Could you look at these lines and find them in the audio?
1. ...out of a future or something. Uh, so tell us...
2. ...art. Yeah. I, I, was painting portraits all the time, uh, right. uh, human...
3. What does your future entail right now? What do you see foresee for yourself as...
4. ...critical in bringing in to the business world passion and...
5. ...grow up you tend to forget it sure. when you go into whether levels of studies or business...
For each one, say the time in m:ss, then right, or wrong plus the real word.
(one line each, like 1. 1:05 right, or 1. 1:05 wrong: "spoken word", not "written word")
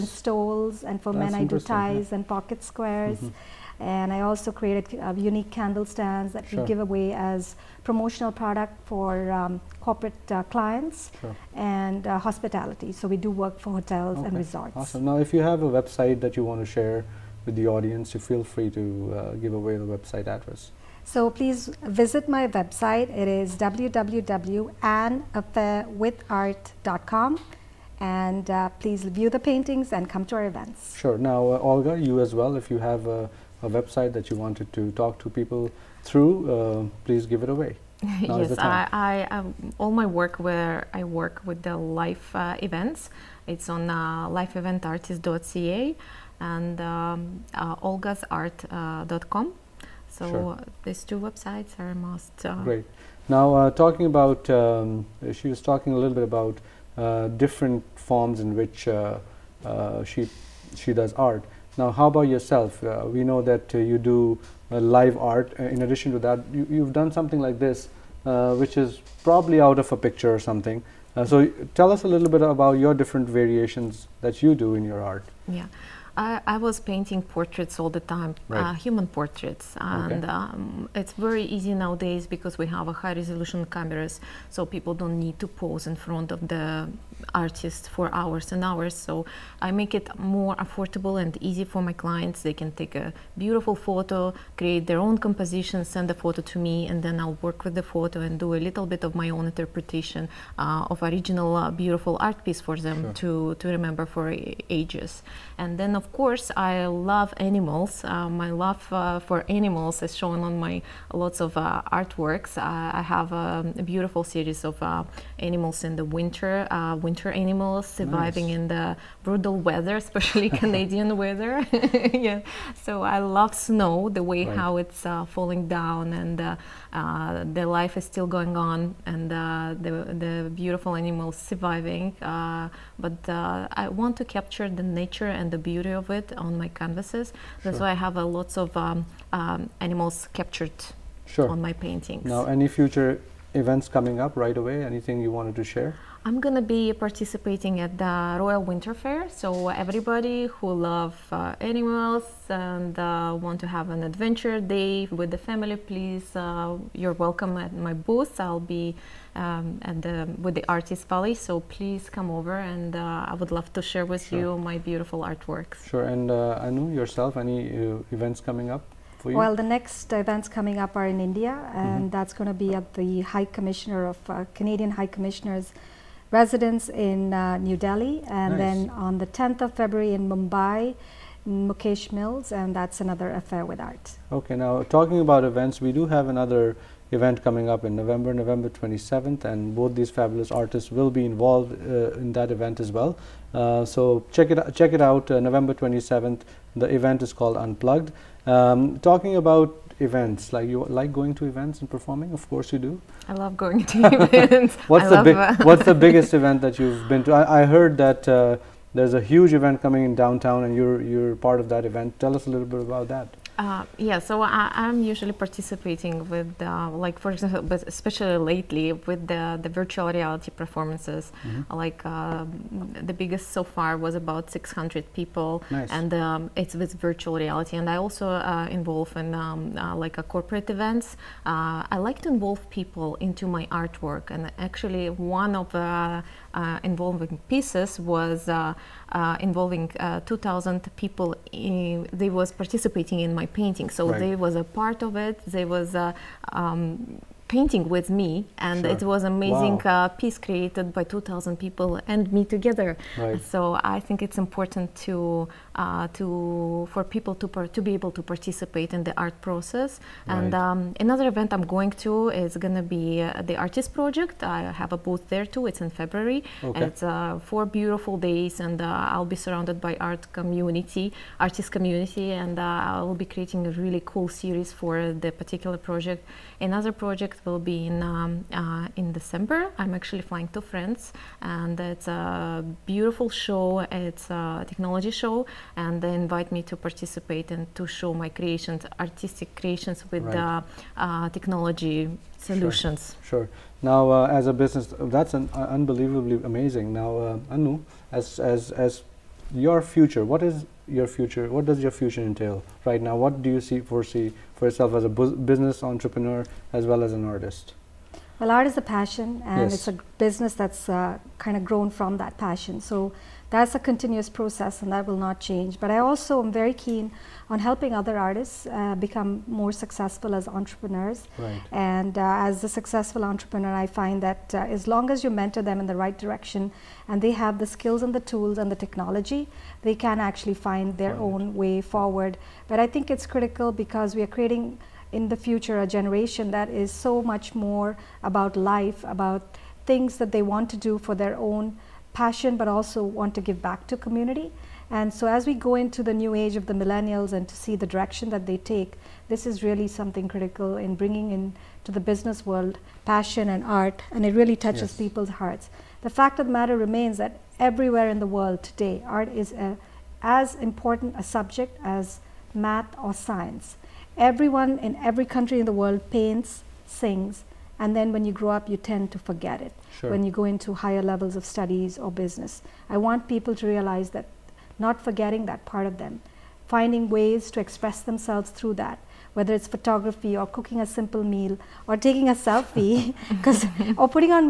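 1. 1:09 wrong: "picture", not "future"
2. 1:15 right
3. 5:01 right
4. 5:50 right
5. 6:08 wrong: "higher", not "whether".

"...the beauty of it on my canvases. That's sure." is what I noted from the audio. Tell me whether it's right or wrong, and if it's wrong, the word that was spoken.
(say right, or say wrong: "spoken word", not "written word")
right.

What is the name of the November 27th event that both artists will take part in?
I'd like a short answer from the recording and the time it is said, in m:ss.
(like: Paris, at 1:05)
Unplugged, at 3:17.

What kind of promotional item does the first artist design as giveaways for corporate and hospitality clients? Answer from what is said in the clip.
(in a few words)
Candle stands.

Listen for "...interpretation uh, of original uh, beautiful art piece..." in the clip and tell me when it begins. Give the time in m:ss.
1:39.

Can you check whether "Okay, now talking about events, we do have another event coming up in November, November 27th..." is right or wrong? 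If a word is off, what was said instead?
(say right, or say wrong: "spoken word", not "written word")
right.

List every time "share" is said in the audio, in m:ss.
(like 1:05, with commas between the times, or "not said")
0:16, 2:25, 2:43.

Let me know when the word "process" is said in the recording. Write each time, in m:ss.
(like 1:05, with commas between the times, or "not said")
4:19, 5:14.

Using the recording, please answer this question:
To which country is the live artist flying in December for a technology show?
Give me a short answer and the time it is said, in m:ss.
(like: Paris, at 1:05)
France, at 4:40.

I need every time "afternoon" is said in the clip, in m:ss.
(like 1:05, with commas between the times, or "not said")
not said.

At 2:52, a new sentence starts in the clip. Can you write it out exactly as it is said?
that's going to be at the High Commissioner of Canadian High Commissioners residence in uh, New Delhi, and nice.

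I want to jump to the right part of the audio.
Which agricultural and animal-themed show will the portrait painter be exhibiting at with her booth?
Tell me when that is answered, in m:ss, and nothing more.
2:28.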